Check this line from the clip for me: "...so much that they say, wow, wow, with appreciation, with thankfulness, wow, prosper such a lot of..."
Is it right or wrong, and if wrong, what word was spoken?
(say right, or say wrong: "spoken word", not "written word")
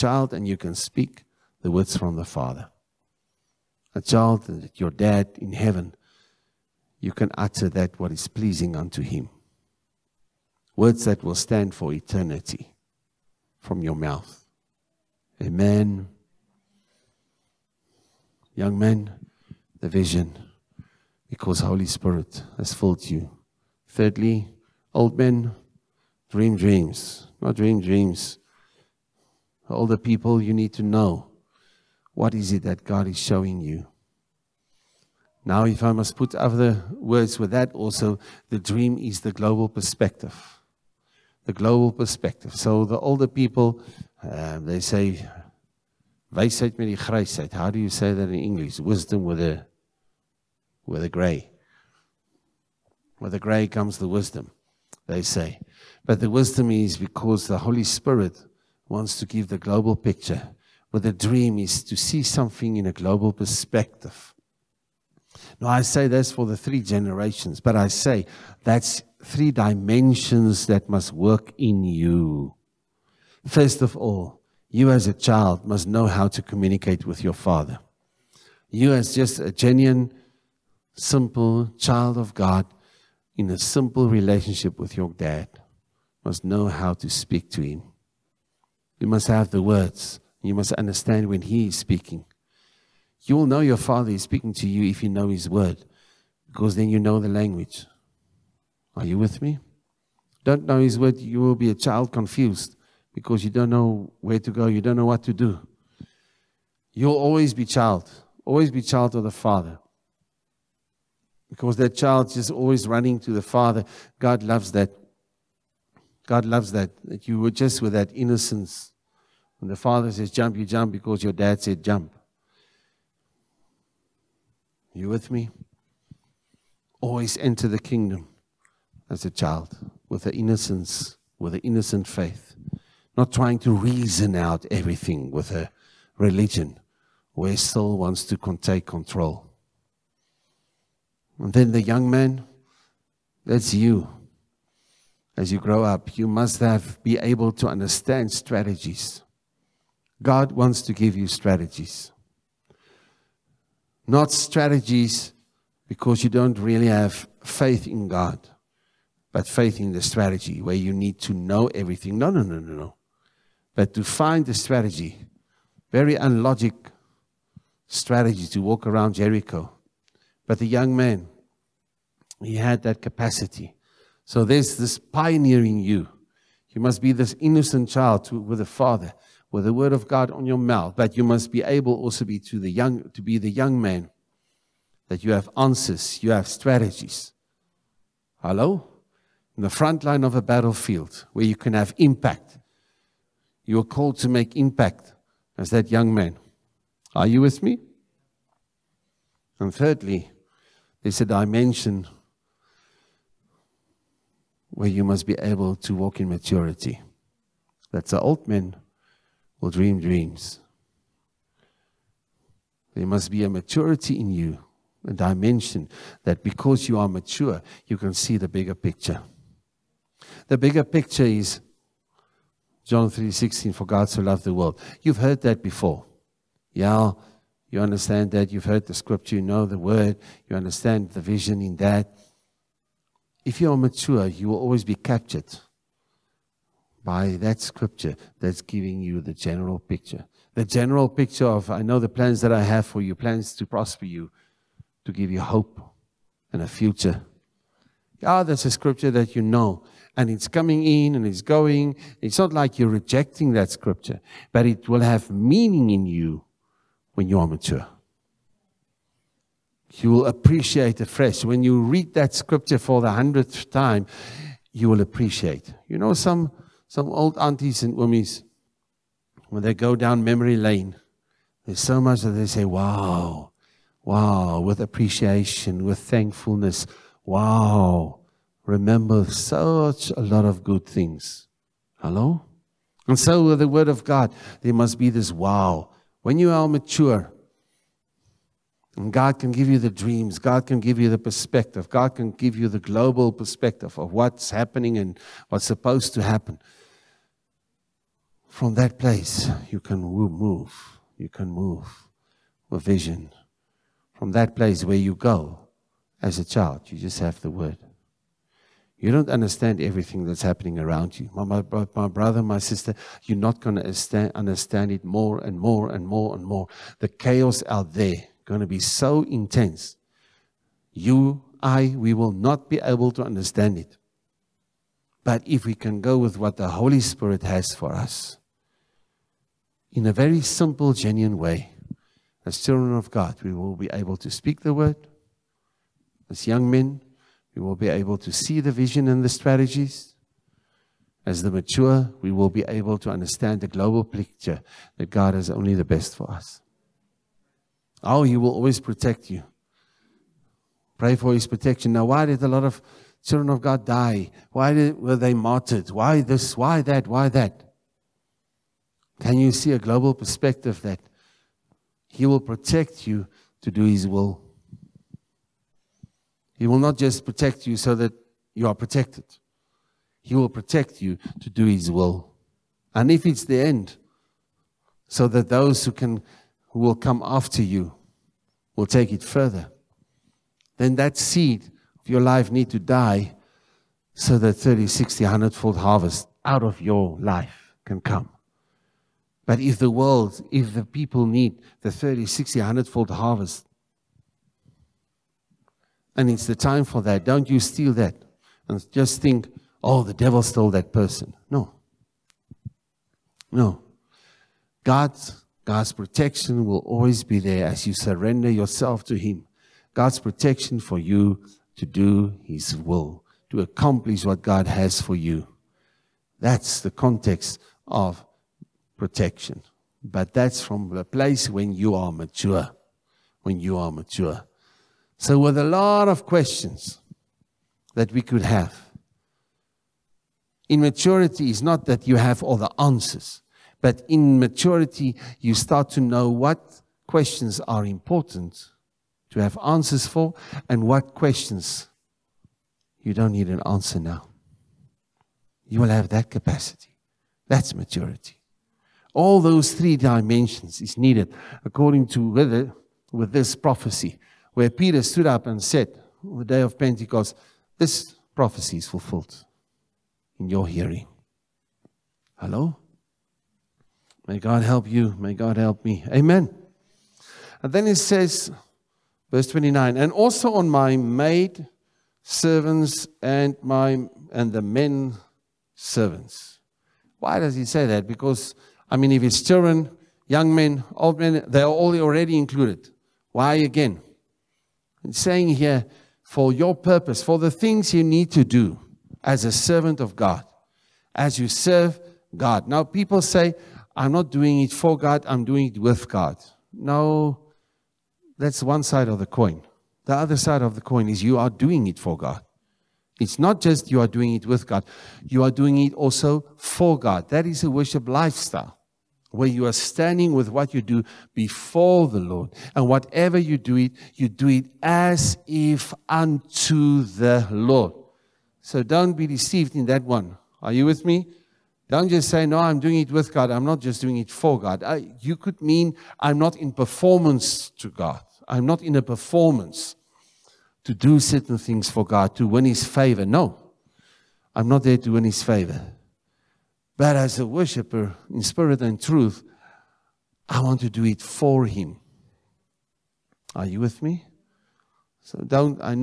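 wrong: "remember", not "prosper".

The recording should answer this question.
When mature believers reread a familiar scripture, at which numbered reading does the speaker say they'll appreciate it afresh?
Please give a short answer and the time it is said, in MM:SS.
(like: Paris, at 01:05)
100th, at 04:23.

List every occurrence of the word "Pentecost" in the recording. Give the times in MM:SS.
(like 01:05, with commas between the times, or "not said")
07:36.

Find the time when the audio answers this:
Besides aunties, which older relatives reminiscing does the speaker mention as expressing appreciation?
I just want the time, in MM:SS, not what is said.
04:27.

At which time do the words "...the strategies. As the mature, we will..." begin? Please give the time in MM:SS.
05:39.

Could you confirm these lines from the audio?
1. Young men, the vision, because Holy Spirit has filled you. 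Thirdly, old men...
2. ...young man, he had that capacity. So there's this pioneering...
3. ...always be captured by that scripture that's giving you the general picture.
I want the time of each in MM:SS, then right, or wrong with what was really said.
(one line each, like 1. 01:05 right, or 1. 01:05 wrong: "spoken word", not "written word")
1. 00:18 right
2. 02:50 right
3. 03:54 right.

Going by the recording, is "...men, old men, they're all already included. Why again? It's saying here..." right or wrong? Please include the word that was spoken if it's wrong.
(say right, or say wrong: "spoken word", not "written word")
right.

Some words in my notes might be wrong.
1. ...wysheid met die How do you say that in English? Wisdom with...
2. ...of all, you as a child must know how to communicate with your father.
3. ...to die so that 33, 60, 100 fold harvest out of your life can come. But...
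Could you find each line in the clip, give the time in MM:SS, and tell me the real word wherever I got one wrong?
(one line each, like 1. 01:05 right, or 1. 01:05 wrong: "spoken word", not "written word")
1. 00:46 right
2. 01:13 right
3. 06:22 wrong: "30", not "33".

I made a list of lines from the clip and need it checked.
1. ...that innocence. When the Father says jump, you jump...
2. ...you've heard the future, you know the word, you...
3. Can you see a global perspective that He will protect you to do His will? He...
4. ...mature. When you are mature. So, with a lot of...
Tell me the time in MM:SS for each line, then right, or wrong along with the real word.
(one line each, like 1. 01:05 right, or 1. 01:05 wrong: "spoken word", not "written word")
1. 01:57 right
2. 03:48 wrong: "scripture", not "future"
3. 05:59 right
4. 07:02 right.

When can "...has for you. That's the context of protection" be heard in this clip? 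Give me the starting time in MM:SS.
06:54.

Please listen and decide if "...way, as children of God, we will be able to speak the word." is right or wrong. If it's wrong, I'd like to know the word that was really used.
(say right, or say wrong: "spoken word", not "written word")
right.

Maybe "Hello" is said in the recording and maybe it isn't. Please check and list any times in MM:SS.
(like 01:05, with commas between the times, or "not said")
03:08, 04:41, 07:42.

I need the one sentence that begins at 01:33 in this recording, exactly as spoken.
You will know your Father is speaking to you if you know His word, because then you know the language.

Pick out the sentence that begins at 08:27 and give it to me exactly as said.
That is a worship lifestyle where you are standing with what you do before the Lord.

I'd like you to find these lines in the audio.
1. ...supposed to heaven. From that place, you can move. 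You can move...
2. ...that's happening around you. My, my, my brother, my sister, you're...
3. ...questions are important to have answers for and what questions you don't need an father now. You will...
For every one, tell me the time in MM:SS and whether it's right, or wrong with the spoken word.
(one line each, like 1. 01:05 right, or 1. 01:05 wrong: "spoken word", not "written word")
1. 04:55 wrong: "happen", not "heaven"
2. 05:10 right
3. 07:17 wrong: "answer", not "father".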